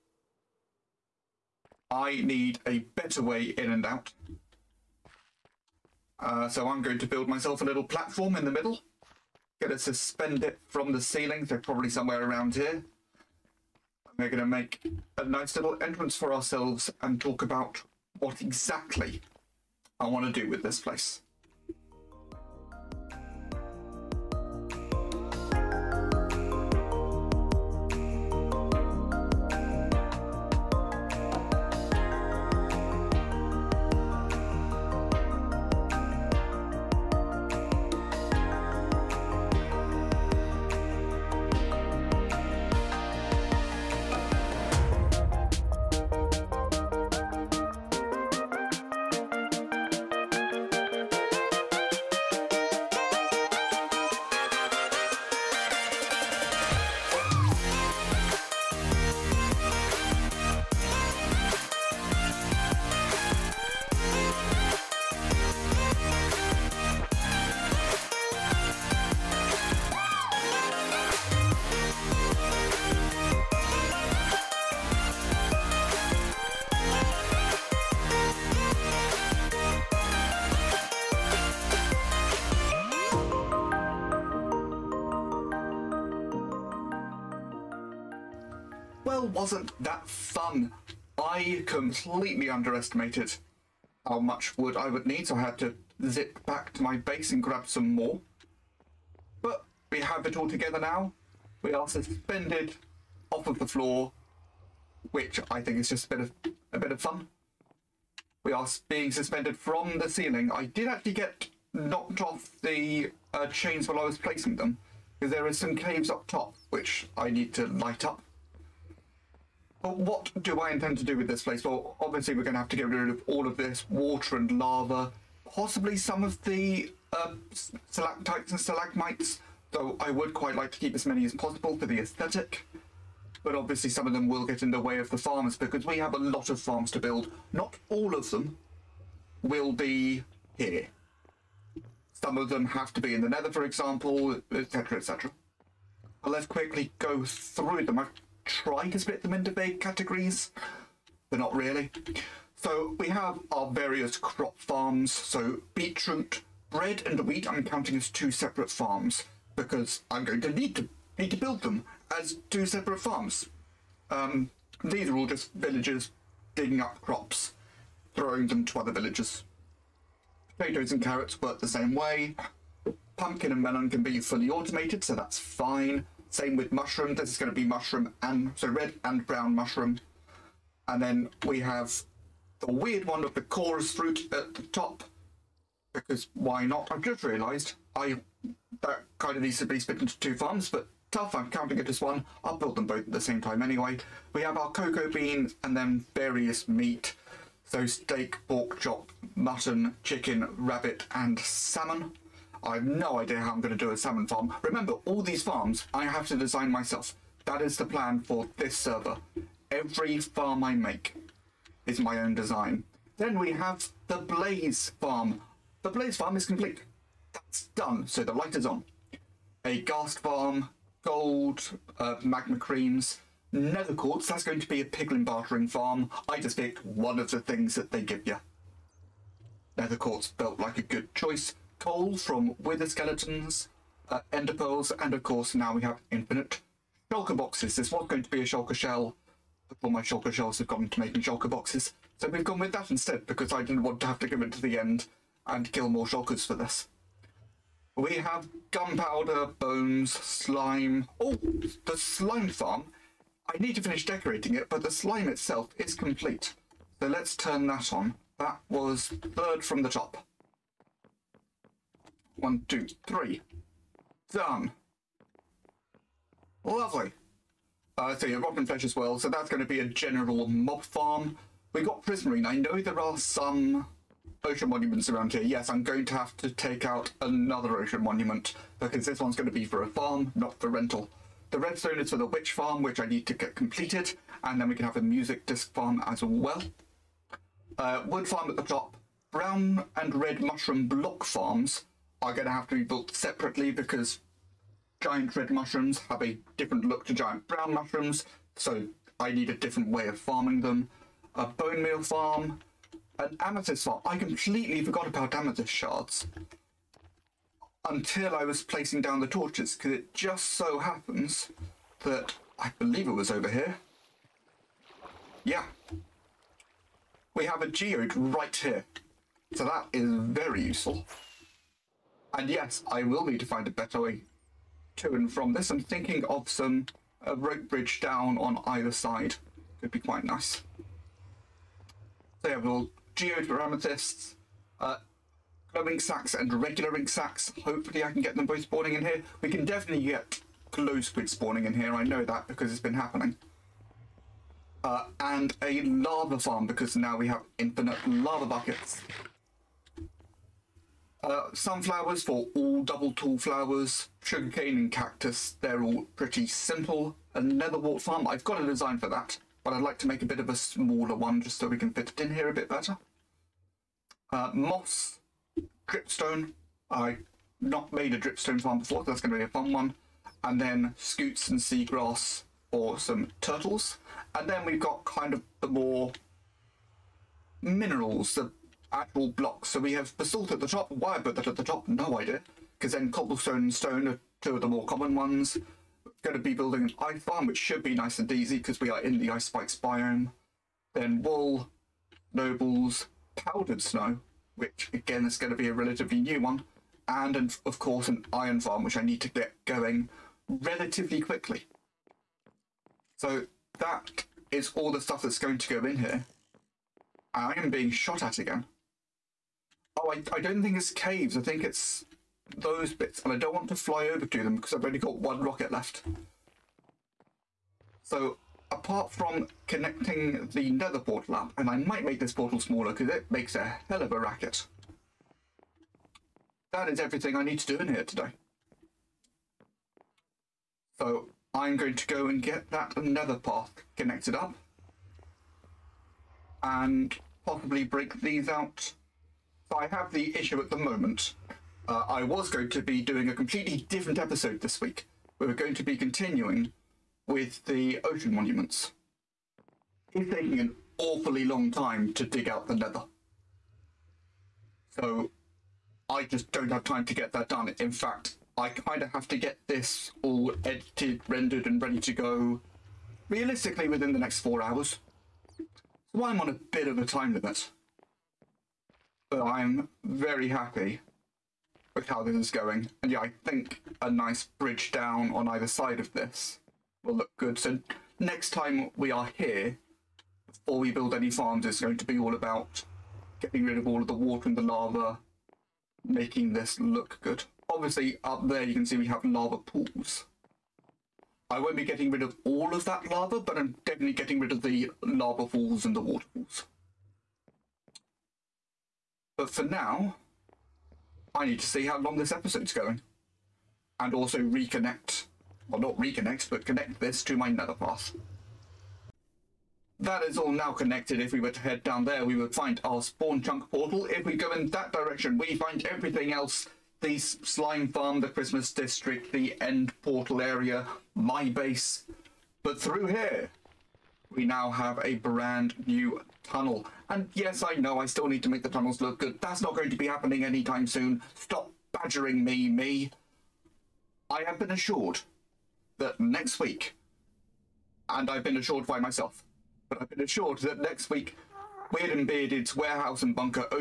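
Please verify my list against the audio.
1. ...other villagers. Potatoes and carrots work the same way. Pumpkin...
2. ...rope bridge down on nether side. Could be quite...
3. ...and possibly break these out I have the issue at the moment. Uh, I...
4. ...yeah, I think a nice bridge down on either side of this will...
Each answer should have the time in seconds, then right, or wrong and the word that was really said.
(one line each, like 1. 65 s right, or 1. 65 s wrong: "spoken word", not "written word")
1. 168 s right
2. 327 s wrong: "either", not "nether"
3. 436 s right
4. 473 s right.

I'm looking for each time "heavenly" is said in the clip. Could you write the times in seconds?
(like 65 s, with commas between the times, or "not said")
not said.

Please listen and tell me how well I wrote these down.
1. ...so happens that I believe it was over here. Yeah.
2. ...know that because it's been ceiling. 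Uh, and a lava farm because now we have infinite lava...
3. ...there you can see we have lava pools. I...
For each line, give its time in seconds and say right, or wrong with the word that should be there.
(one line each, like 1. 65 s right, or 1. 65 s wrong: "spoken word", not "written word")
1. 310 s right
2. 342 s wrong: "happening", not "ceiling"
3. 488 s right.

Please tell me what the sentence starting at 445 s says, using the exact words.
We were going to be continuing with the ocean monuments.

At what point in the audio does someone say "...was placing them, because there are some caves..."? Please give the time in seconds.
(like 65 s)
114 s.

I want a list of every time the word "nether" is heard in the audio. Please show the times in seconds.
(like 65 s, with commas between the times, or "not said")
143 s, 223 s, 229 s, 357 s, 420 s, 433 s, 507 s.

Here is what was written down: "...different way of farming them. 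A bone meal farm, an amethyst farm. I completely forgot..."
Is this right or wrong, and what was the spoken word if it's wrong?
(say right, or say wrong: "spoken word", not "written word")
right.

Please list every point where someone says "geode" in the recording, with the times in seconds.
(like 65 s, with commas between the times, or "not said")
317 s, 333 s.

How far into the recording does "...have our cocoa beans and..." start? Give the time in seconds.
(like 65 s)
194 s.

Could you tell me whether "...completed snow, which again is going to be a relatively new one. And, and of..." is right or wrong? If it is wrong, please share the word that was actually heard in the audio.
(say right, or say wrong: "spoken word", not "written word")
wrong: "powdered", not "completed".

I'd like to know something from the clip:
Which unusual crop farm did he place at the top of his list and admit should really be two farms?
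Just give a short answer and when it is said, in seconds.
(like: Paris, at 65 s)
Chorus fruit, at 183 s.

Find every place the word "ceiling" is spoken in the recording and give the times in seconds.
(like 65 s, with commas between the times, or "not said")
11 s, 110 s.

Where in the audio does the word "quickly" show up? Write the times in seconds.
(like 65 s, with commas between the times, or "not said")
146 s, 401 s.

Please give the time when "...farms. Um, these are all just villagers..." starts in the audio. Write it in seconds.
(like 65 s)
163 s.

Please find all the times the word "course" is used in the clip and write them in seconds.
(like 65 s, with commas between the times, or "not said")
235 s, 397 s.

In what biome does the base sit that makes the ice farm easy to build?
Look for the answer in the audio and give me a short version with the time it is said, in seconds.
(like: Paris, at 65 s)
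Ice spikes biome, at 389 s.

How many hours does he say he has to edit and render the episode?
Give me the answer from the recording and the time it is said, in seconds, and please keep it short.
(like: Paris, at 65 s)
4, at 464 s.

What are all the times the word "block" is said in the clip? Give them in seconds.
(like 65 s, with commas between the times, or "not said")
290 s, 379 s.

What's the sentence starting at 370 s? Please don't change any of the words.
And then scutes and seagrass for some turtles.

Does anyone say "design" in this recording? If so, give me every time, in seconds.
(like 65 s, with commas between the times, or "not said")
206 s, 212 s, 358 s.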